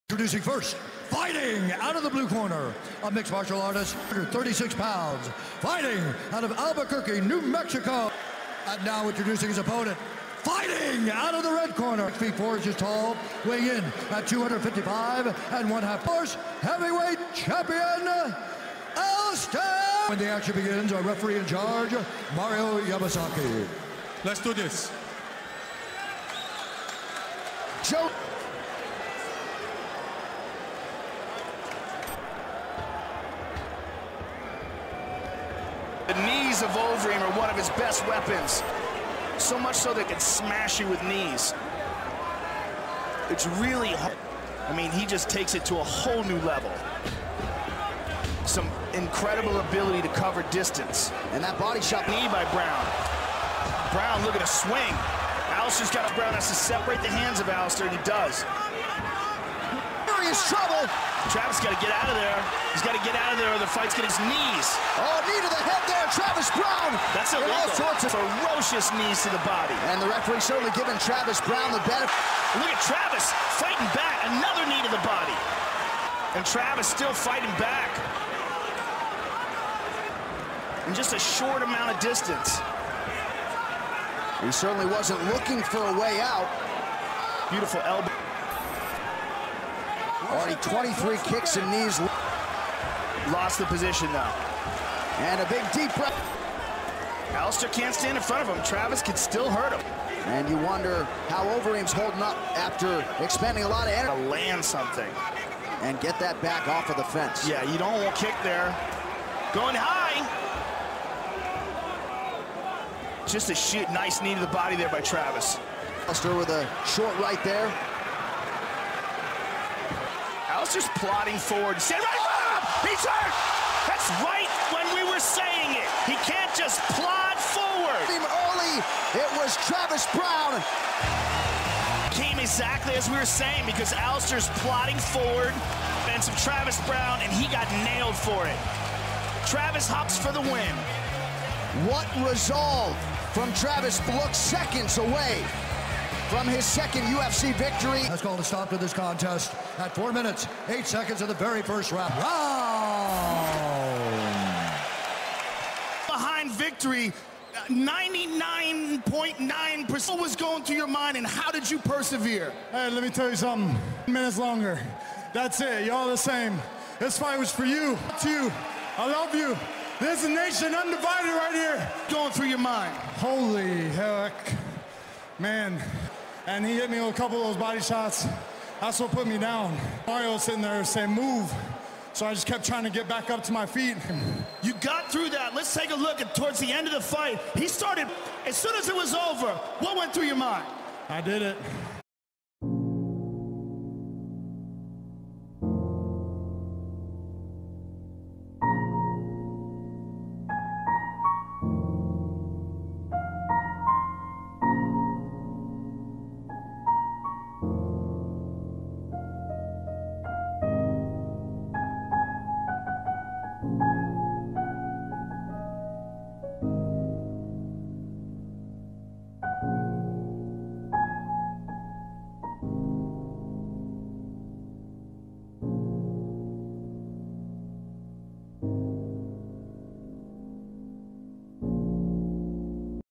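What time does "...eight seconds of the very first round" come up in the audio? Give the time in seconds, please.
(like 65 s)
150 s.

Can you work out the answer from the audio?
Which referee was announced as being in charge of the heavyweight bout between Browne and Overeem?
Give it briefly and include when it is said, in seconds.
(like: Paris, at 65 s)
Mario Yamasaki, at 22 s.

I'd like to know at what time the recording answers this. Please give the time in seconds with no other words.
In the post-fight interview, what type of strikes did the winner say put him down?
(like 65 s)
177 s.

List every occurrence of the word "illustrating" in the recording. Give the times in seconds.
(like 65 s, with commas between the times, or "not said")
not said.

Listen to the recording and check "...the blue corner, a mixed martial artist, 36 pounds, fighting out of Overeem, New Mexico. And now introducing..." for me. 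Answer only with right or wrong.
wrong.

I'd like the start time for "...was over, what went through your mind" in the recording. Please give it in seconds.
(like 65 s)
188 s.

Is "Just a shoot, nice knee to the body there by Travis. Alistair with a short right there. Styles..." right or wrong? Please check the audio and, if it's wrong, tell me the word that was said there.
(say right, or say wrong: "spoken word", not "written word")
right.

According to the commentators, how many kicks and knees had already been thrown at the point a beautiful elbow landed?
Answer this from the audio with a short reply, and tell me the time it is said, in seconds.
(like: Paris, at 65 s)
23, at 90 s.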